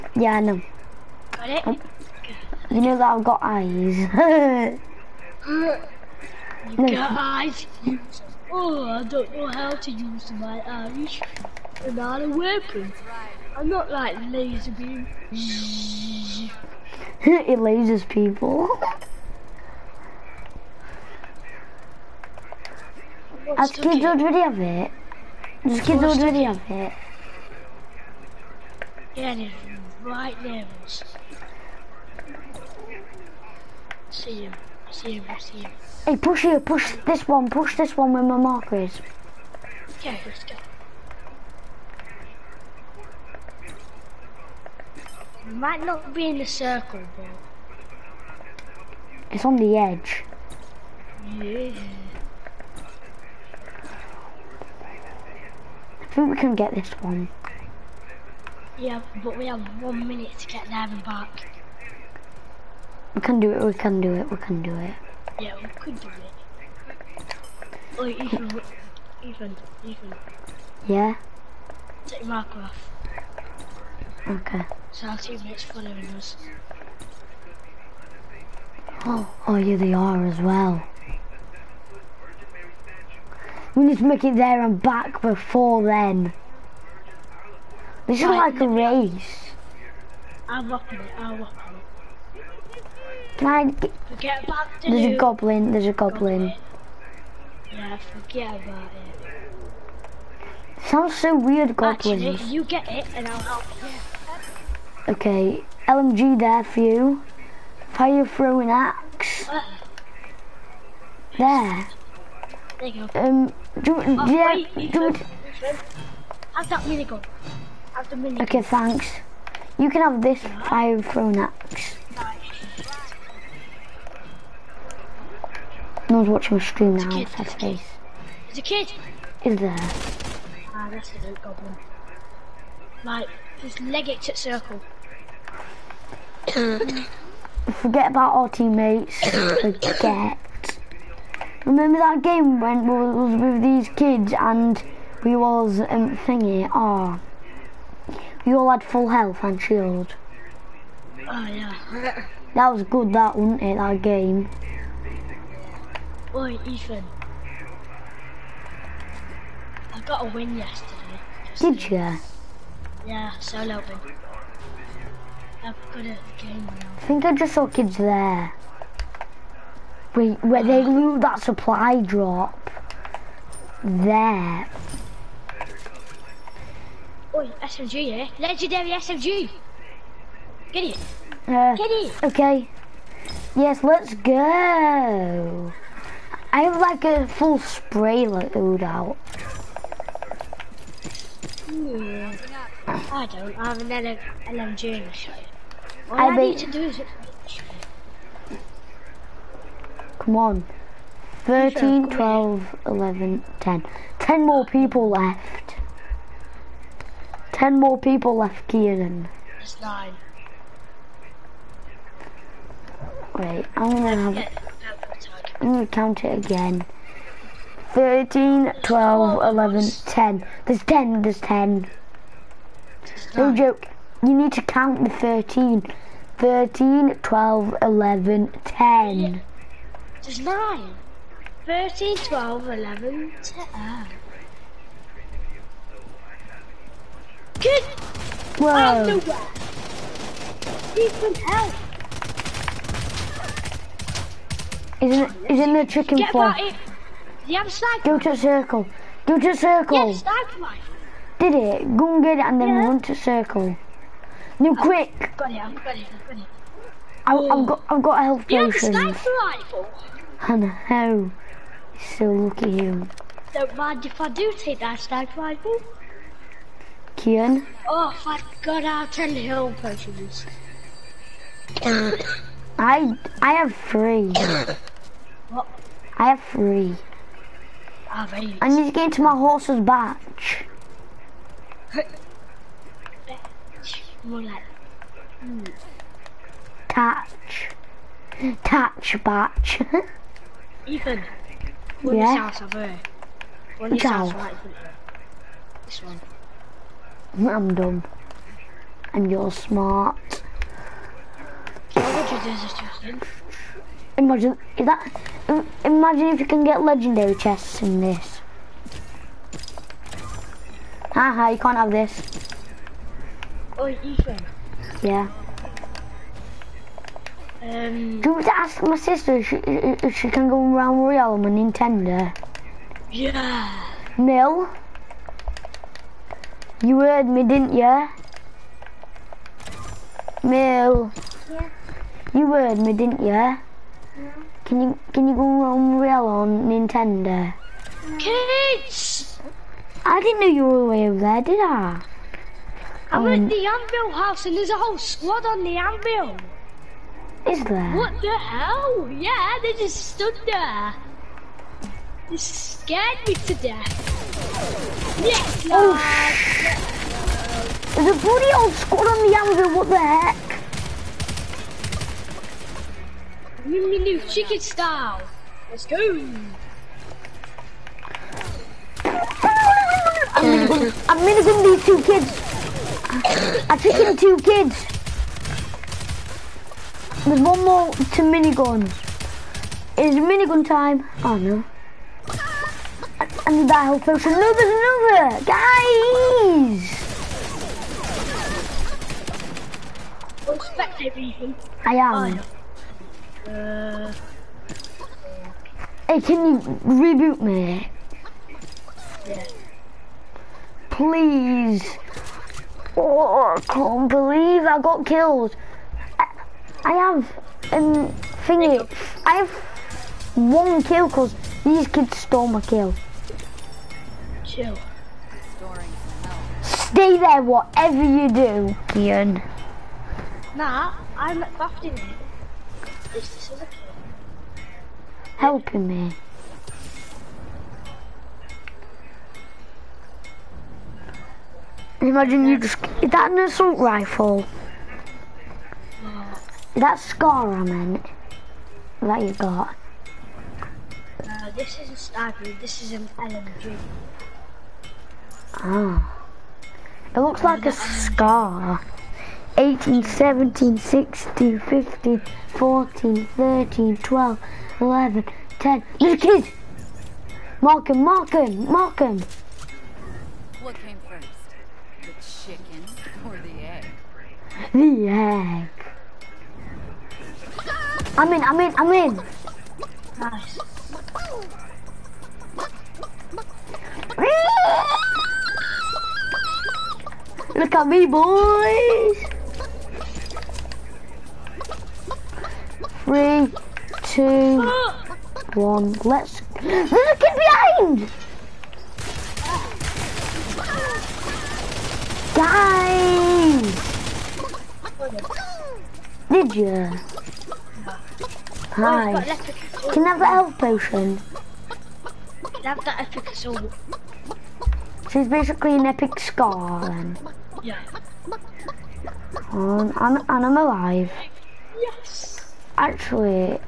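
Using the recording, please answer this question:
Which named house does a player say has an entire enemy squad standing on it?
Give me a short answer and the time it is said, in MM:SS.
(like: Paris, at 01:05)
Anvil house, at 05:43.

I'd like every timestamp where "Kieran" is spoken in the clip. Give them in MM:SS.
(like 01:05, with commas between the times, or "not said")
03:28.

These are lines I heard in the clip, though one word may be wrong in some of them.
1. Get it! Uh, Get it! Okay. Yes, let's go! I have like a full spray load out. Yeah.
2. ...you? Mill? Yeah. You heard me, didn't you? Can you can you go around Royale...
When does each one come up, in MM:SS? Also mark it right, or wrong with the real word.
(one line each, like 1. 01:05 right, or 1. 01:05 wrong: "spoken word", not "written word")
1. 03:00 right
2. 05:27 right.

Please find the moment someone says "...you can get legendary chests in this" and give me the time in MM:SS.
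05:06.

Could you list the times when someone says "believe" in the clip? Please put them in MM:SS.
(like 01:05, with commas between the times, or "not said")
06:44.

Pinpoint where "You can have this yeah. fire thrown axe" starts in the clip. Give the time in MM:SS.
01:59.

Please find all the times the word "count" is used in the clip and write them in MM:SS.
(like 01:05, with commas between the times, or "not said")
03:35, 03:44.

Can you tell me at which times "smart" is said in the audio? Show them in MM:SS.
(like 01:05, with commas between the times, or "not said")
04:59.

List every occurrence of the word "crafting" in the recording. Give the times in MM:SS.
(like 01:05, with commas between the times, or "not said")
07:01.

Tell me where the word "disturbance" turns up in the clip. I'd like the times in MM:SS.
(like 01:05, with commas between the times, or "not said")
not said.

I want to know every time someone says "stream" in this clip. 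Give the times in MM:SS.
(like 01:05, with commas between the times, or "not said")
02:06.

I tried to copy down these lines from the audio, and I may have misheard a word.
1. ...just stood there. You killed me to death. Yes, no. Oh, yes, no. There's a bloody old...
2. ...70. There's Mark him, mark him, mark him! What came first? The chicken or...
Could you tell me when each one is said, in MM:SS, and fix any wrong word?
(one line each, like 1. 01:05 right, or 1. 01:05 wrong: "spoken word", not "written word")
1. 05:49 wrong: "scared", not "killed"
2. 07:35 wrong: "10", not "70".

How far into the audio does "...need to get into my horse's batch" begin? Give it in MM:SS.
04:38.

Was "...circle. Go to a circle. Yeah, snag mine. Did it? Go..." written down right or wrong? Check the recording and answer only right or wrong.
right.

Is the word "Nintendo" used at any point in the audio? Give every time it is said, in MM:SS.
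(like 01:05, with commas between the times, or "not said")
05:21, 05:36.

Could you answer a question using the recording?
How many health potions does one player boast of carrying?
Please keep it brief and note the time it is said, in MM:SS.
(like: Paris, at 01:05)
10, at 04:29.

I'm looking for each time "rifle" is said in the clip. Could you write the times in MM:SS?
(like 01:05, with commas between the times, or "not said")
04:19, 04:25, 07:13.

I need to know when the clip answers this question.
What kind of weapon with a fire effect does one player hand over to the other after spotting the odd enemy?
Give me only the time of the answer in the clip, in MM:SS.
01:47.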